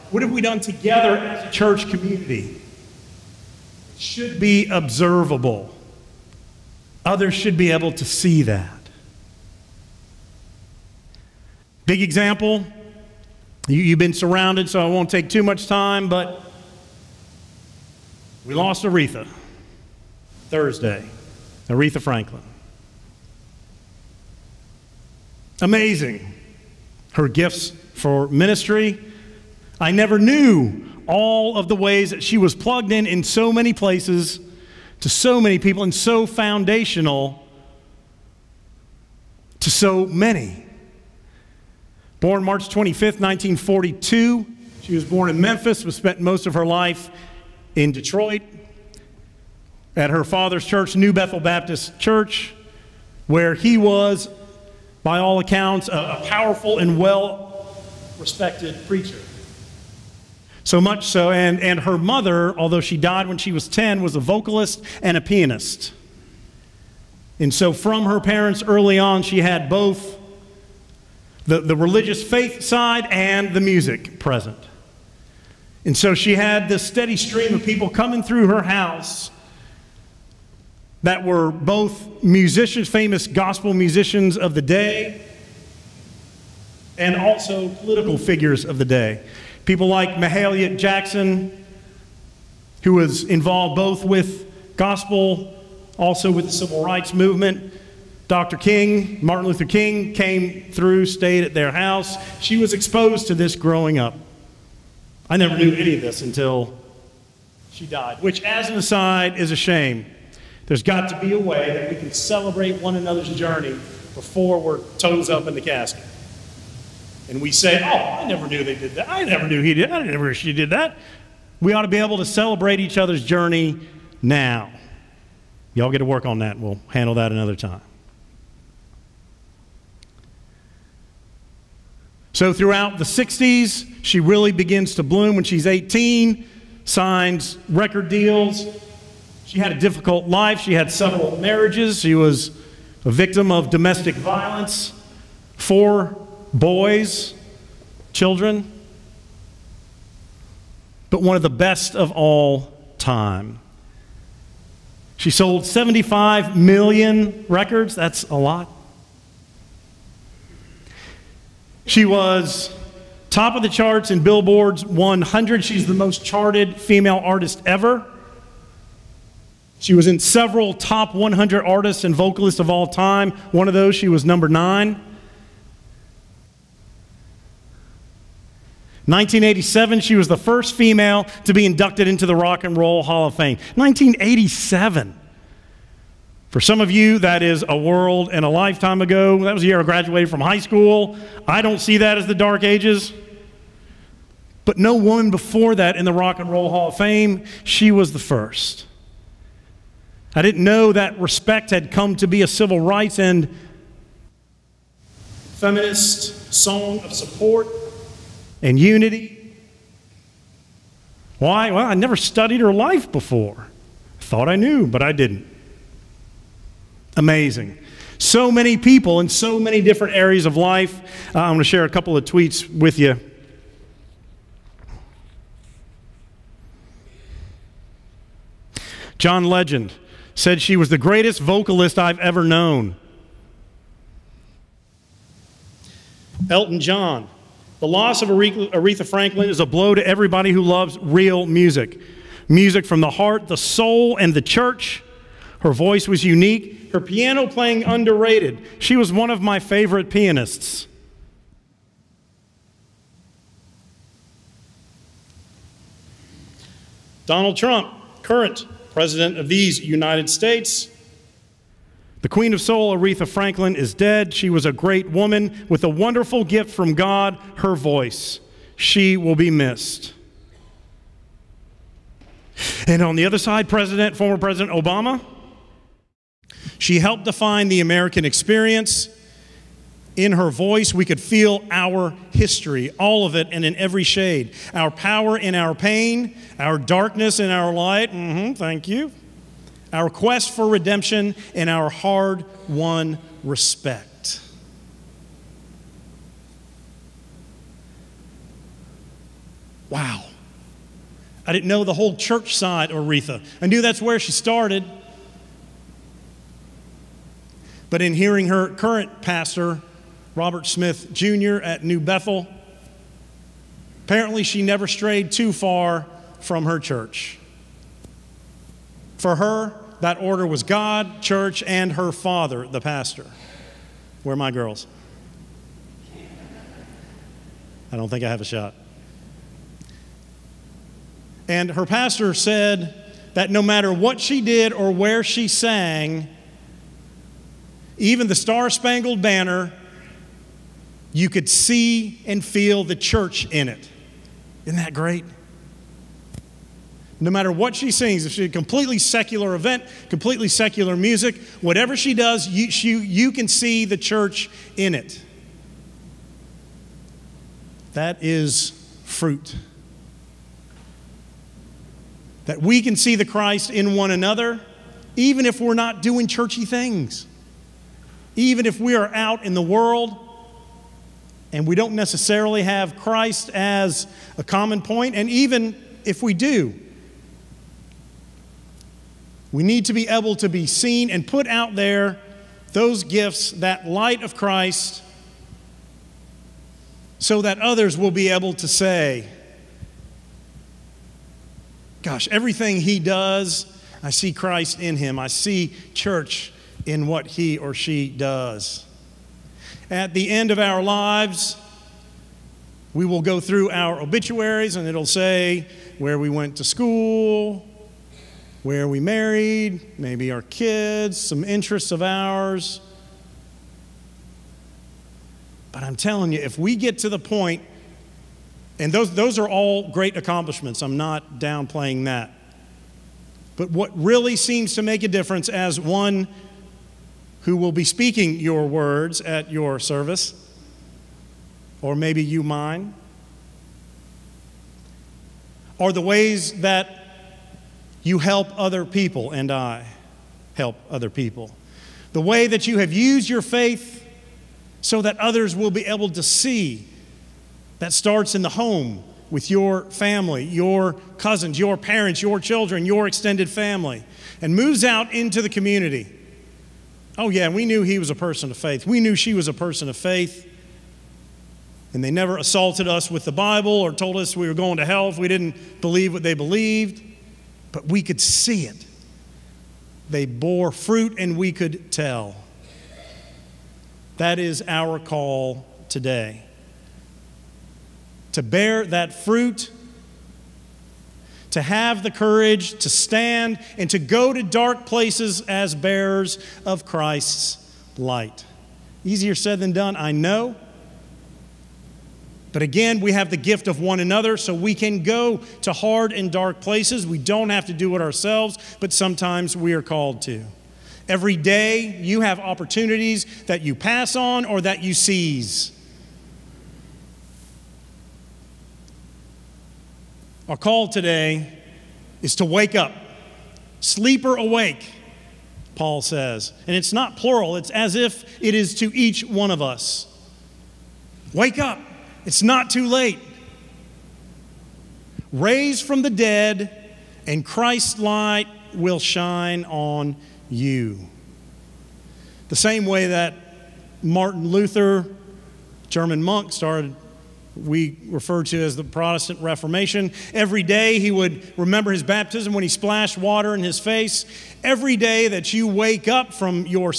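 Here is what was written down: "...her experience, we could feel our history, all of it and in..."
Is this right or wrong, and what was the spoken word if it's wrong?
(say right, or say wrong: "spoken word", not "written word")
wrong: "voice", not "experience".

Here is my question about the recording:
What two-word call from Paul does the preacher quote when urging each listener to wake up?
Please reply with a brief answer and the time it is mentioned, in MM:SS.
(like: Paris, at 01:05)
Sleeper awake, at 08:33.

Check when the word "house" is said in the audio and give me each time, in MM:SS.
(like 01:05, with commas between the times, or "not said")
01:18, 01:41.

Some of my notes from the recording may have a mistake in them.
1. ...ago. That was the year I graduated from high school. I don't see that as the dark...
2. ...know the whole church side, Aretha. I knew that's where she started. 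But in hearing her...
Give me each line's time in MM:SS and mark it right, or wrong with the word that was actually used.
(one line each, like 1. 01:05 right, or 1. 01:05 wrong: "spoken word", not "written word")
1. 03:09 right
2. 05:01 right.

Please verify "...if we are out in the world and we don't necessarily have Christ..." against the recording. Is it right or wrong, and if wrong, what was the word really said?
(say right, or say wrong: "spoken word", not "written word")
right.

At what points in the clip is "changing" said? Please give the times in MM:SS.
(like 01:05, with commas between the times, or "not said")
not said.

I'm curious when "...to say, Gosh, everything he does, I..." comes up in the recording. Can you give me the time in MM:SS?
06:28.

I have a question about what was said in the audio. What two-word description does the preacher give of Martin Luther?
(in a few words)
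German monk.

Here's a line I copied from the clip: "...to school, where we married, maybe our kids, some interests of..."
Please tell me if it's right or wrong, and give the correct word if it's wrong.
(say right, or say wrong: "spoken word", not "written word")
right.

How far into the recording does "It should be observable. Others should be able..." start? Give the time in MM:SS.
00:03.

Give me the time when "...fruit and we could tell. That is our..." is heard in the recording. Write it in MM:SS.
07:50.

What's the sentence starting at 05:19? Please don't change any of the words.
For her, that order was God, church, and her father, the pastor.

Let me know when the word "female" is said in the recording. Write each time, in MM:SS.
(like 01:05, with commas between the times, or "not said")
02:46, 03:00.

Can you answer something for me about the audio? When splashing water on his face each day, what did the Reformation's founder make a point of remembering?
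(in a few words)
His baptism.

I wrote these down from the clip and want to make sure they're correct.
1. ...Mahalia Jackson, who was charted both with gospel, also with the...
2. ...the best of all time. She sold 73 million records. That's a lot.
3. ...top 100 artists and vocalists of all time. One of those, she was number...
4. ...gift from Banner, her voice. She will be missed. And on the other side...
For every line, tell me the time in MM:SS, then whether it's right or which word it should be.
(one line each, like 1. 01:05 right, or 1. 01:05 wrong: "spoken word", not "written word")
1. 01:30 wrong: "involved", not "charted"
2. 02:31 wrong: "75", not "73"
3. 02:50 right
4. 04:26 wrong: "God", not "Banner".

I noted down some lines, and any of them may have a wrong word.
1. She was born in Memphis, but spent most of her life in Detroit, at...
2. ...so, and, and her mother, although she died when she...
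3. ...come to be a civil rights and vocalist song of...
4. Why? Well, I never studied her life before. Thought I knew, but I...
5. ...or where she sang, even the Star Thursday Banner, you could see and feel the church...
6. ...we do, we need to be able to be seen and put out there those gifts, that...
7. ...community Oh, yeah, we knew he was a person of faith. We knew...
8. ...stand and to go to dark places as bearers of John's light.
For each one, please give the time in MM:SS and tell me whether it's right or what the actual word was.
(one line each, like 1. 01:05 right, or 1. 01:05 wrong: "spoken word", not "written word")
1. 00:44 right
2. 01:01 right
3. 03:21 wrong: "feminist", not "vocalist"
4. 03:31 right
5. 05:34 wrong: "Spangled", not "Thursday"
6. 06:16 right
7. 07:35 right
8. 08:02 wrong: "Christ", not "John".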